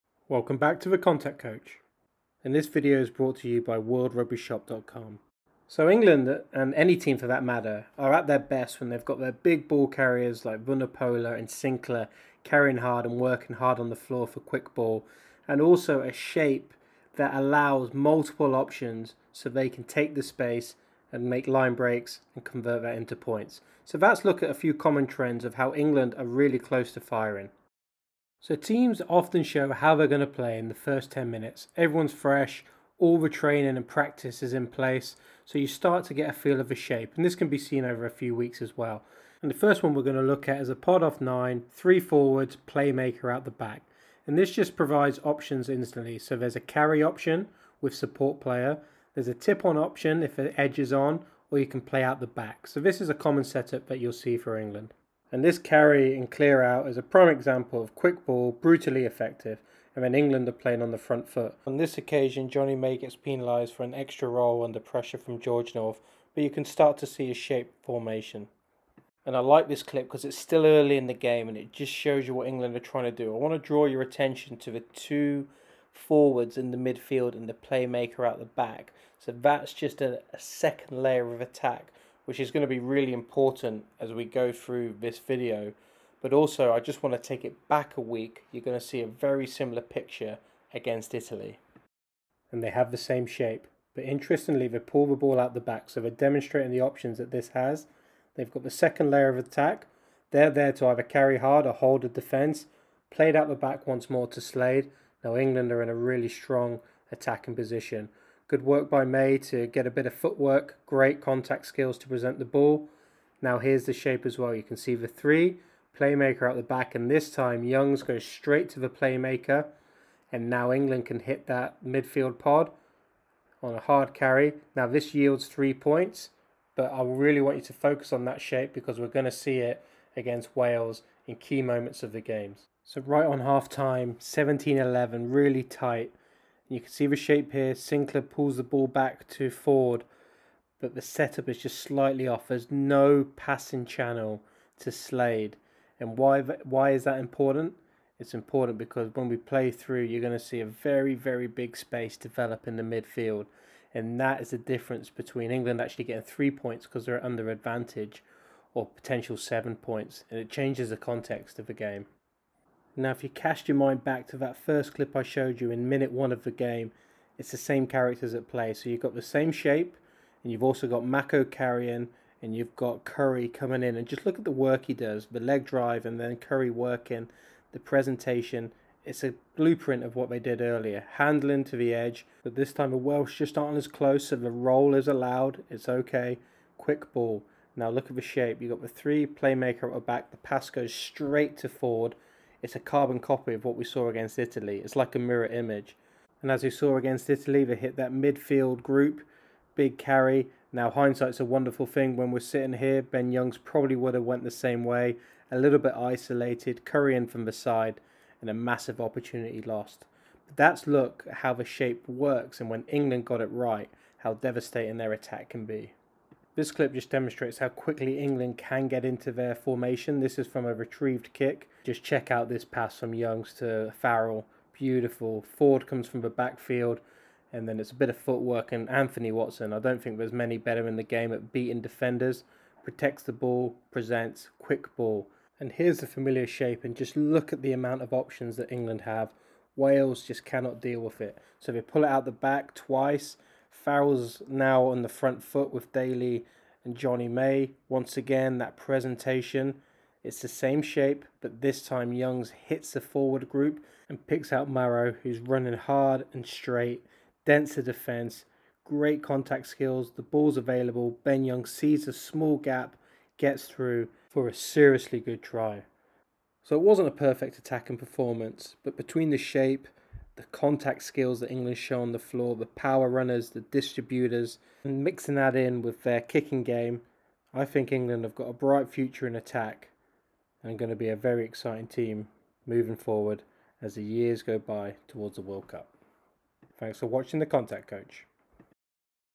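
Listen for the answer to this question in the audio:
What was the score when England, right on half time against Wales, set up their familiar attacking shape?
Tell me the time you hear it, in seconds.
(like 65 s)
134 s.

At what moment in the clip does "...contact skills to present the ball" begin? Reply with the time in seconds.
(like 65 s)
111 s.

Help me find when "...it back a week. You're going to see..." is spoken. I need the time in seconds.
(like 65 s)
87 s.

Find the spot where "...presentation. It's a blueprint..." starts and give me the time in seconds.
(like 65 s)
177 s.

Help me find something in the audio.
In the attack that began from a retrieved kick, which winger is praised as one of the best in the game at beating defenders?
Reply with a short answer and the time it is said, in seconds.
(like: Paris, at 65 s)
Anthony Watson, at 228 s.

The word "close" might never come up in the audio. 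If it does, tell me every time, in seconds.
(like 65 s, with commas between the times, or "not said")
26 s, 183 s.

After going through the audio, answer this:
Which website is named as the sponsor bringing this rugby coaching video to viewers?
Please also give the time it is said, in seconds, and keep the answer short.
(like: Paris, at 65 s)
worldrugbyshop.com, at 3 s.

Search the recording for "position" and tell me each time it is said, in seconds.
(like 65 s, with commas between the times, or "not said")
107 s.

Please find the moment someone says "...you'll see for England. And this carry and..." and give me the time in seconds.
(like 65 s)
53 s.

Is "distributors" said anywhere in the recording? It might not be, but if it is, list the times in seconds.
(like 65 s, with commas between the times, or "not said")
273 s.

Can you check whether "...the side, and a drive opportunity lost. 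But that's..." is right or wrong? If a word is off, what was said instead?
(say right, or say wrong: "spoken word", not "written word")
wrong: "massive", not "drive".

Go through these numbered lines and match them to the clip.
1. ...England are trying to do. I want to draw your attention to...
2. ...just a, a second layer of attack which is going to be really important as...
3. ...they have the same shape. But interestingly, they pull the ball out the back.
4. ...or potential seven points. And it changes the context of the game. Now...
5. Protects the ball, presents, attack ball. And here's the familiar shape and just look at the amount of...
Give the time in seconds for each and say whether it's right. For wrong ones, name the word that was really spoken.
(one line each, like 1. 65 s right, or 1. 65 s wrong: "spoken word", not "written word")
1. 72 s right
2. 79 s right
3. 92 s right
4. 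158 s right
5. 232 s wrong: "quick", not "attack".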